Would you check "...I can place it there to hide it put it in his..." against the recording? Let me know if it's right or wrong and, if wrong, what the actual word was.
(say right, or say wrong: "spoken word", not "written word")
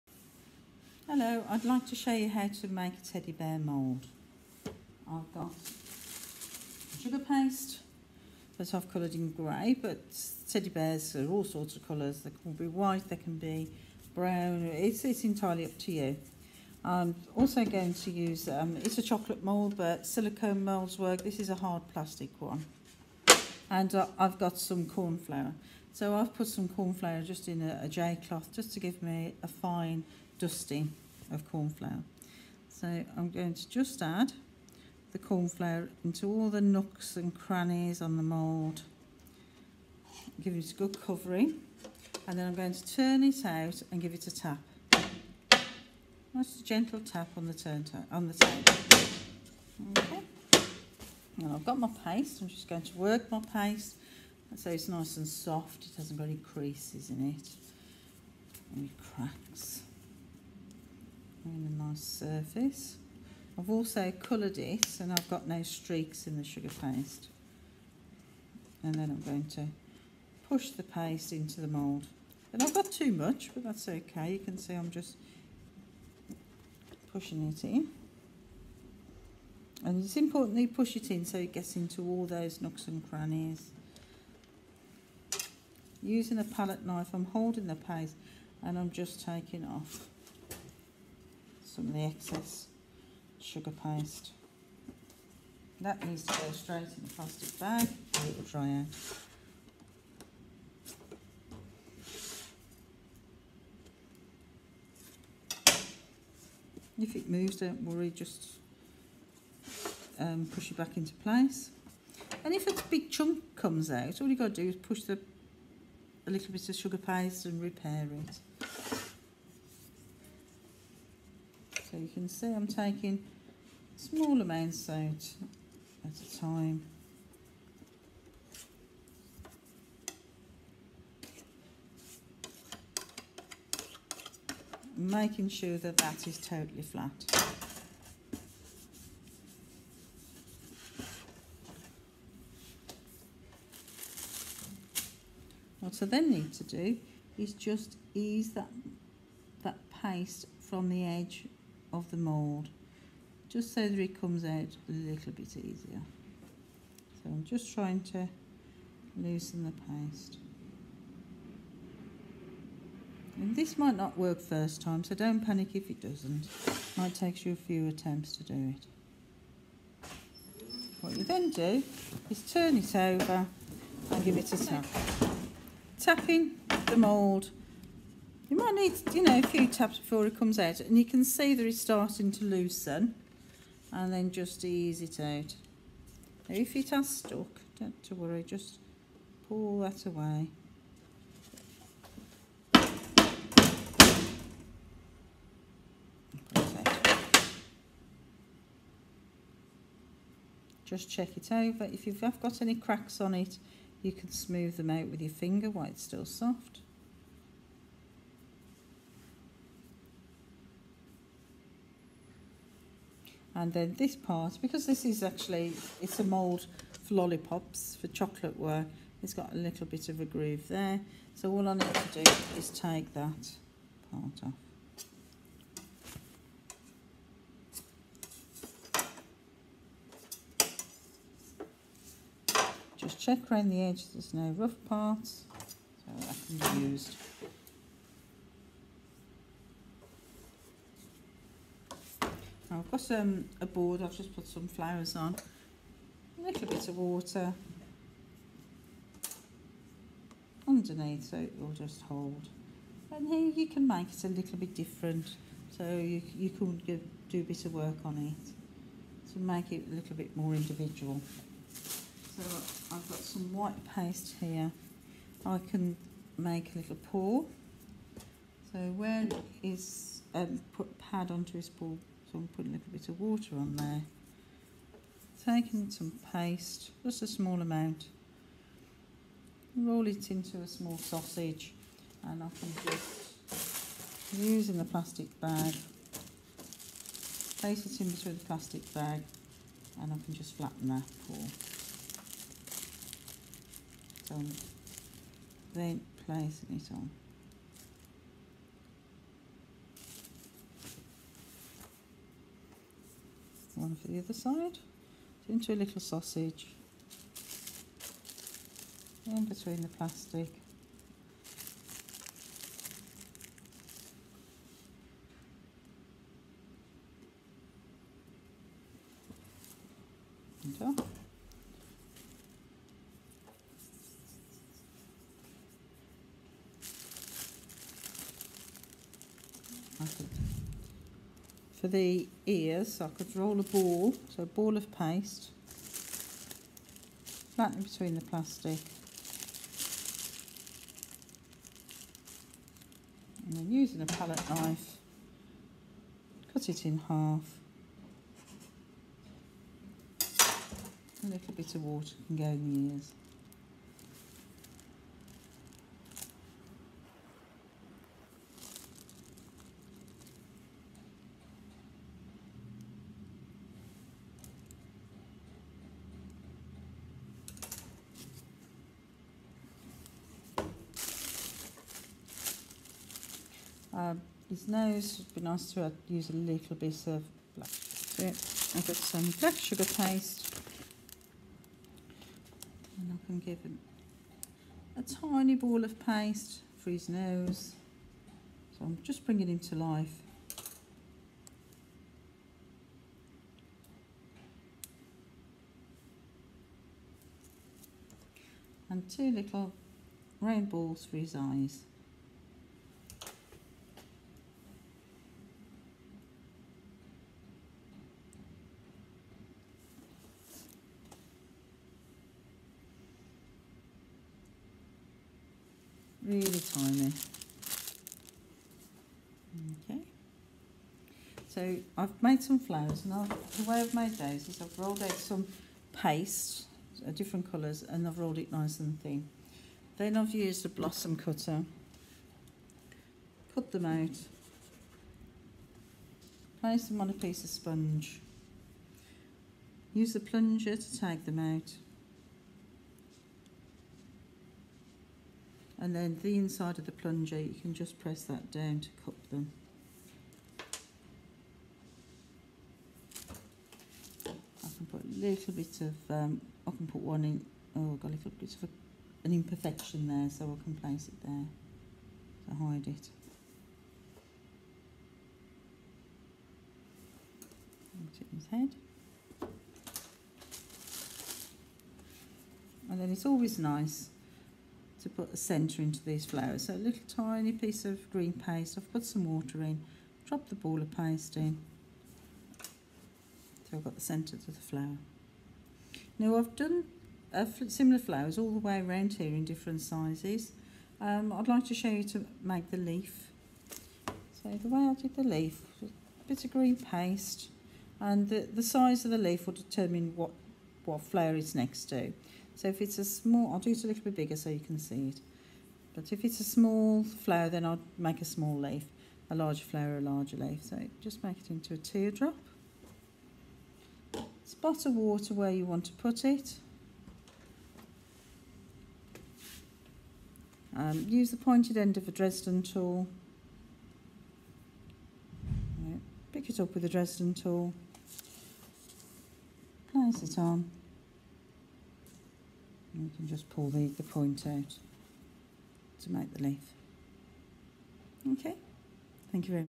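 right.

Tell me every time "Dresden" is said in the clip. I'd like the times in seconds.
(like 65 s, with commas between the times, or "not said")
522 s, 526 s.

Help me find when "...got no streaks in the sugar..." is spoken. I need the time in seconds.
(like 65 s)
65 s.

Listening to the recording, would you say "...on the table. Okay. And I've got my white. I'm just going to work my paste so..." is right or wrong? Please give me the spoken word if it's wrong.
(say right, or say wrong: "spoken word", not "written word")
wrong: "paste", not "white".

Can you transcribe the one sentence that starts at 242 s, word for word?
I've got um, a board, I've just put some flowers on, a little bit of water underneath so it will just hold.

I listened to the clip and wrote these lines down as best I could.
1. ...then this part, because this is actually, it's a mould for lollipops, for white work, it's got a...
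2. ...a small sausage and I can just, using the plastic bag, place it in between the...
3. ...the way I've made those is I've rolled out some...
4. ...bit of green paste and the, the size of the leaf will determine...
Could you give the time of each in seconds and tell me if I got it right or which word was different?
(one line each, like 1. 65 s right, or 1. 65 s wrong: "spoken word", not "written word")
1. 213 s wrong: "chocolate", not "white"
2. 280 s right
3. 423 s right
4. 496 s right.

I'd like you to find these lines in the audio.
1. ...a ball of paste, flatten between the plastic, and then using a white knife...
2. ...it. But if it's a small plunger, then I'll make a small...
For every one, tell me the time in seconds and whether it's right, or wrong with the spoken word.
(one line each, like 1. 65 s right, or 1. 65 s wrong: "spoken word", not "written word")
1. 334 s wrong: "palette", not "white"
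2. 505 s wrong: "flower", not "plunger".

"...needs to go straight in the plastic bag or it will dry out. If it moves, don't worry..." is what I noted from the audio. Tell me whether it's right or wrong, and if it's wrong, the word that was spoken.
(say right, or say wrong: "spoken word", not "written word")
right.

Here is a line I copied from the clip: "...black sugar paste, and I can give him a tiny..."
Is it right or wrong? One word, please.
right.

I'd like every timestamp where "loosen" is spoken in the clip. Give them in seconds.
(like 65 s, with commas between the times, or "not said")
159 s, 182 s.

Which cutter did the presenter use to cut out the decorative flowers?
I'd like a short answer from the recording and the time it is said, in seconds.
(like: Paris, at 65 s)
blossom cutter, at 430 s.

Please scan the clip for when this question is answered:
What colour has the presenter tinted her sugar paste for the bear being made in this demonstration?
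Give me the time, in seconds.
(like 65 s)
8 s.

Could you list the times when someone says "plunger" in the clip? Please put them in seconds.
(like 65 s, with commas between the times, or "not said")
440 s, 446 s.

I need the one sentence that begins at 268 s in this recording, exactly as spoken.
So where is um, put pad onto his paw so I'm putting a little bit of water on there.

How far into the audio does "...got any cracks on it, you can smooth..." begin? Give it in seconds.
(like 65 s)
202 s.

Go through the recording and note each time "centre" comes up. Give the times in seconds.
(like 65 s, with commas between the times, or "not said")
475 s, 484 s.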